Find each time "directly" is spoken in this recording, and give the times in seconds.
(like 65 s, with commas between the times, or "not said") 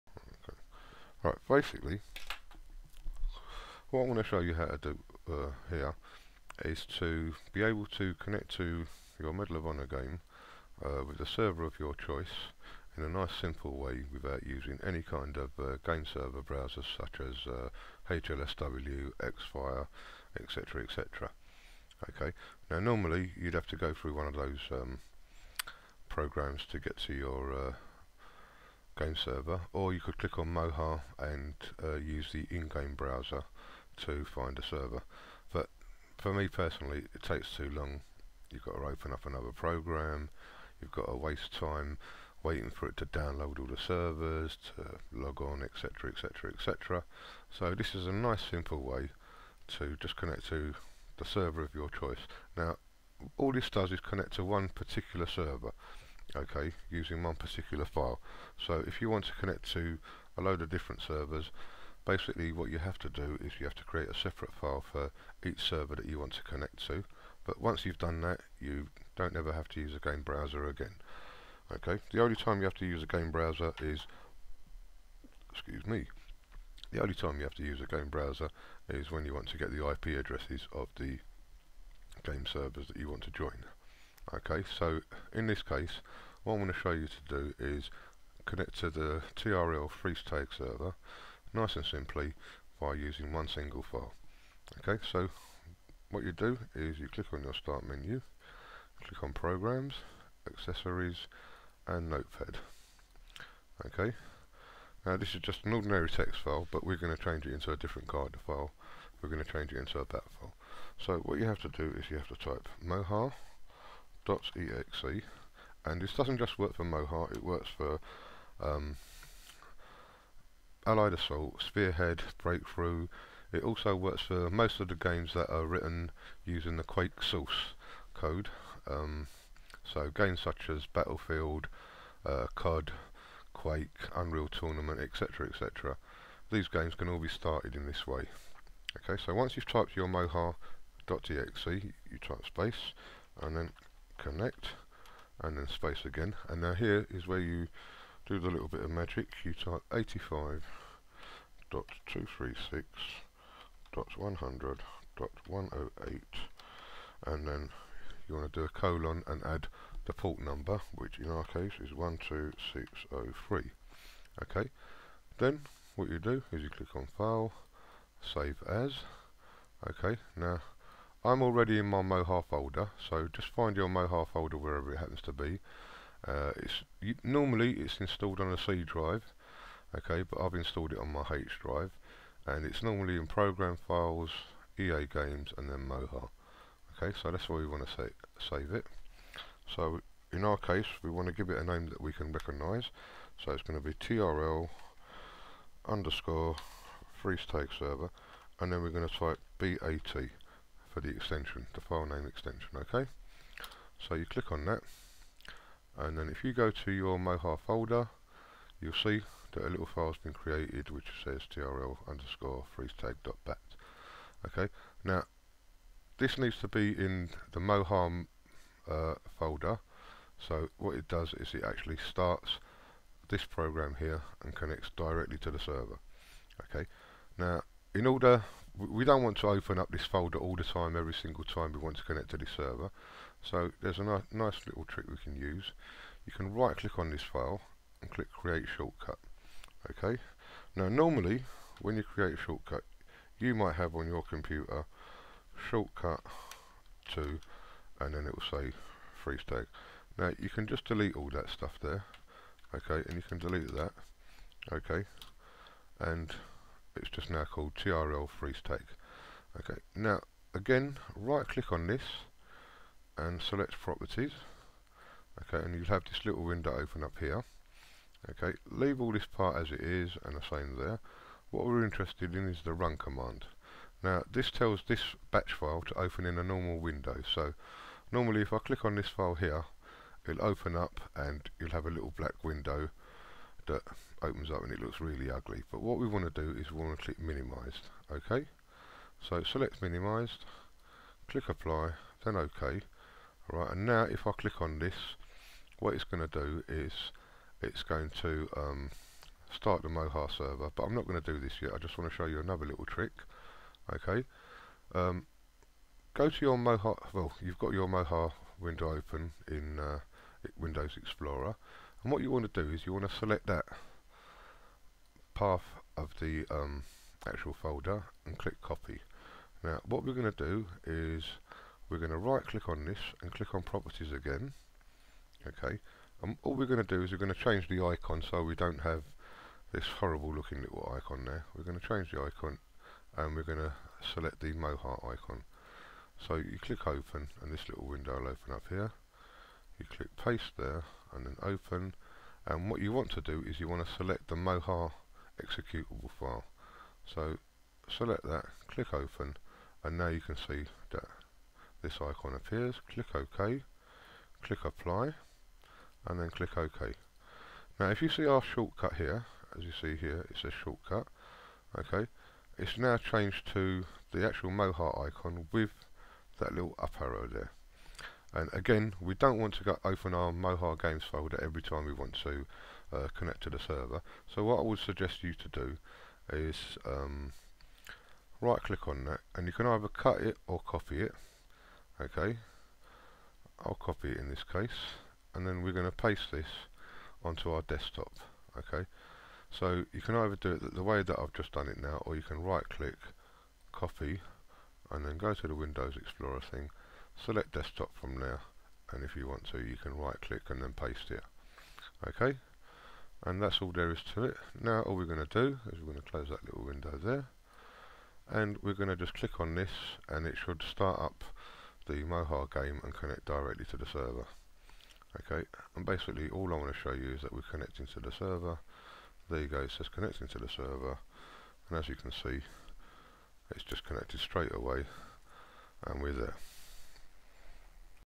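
224 s, 413 s.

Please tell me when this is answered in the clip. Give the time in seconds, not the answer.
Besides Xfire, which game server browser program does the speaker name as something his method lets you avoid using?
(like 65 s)
18 s.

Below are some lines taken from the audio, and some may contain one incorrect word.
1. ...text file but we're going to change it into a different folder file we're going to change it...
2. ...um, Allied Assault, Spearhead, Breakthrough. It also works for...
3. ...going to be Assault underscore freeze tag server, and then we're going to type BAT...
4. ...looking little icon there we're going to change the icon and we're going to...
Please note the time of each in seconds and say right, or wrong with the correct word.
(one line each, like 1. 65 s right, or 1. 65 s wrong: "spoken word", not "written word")
1. 106 s wrong: "character", not "folder"
2. 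118 s right
3. 193 s wrong: "TRL", not "Assault"
4. 330 s right.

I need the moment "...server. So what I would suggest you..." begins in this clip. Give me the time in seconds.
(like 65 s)
373 s.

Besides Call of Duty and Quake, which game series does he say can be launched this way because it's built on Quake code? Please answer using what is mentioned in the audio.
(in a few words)
Battlefield.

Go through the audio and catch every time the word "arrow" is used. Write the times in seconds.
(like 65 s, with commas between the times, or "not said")
367 s.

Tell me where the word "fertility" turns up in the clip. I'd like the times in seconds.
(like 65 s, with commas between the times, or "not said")
not said.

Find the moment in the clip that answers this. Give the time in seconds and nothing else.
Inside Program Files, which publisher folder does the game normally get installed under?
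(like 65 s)
184 s.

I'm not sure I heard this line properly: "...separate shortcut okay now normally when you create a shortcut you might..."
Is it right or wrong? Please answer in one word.
wrong.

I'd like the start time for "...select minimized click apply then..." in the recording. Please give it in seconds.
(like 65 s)
289 s.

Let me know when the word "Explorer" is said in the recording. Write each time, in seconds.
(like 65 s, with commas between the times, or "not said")
310 s, 395 s.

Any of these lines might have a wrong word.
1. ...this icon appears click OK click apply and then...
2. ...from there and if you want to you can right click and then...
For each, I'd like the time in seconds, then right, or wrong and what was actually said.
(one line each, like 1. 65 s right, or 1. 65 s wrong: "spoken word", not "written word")
1. 351 s right
2. 397 s right.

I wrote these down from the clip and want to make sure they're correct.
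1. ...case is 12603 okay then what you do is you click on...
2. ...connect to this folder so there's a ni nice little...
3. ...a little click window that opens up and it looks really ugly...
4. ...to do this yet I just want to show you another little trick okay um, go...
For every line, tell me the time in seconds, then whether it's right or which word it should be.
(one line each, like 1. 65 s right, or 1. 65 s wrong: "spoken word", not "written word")
1. 161 s right
2. 232 s wrong: "server", not "folder"
3. 281 s wrong: "black", not "click"
4. 301 s right.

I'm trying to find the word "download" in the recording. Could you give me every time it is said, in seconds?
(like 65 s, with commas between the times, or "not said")
43 s.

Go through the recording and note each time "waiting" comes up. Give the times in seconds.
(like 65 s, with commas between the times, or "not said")
42 s.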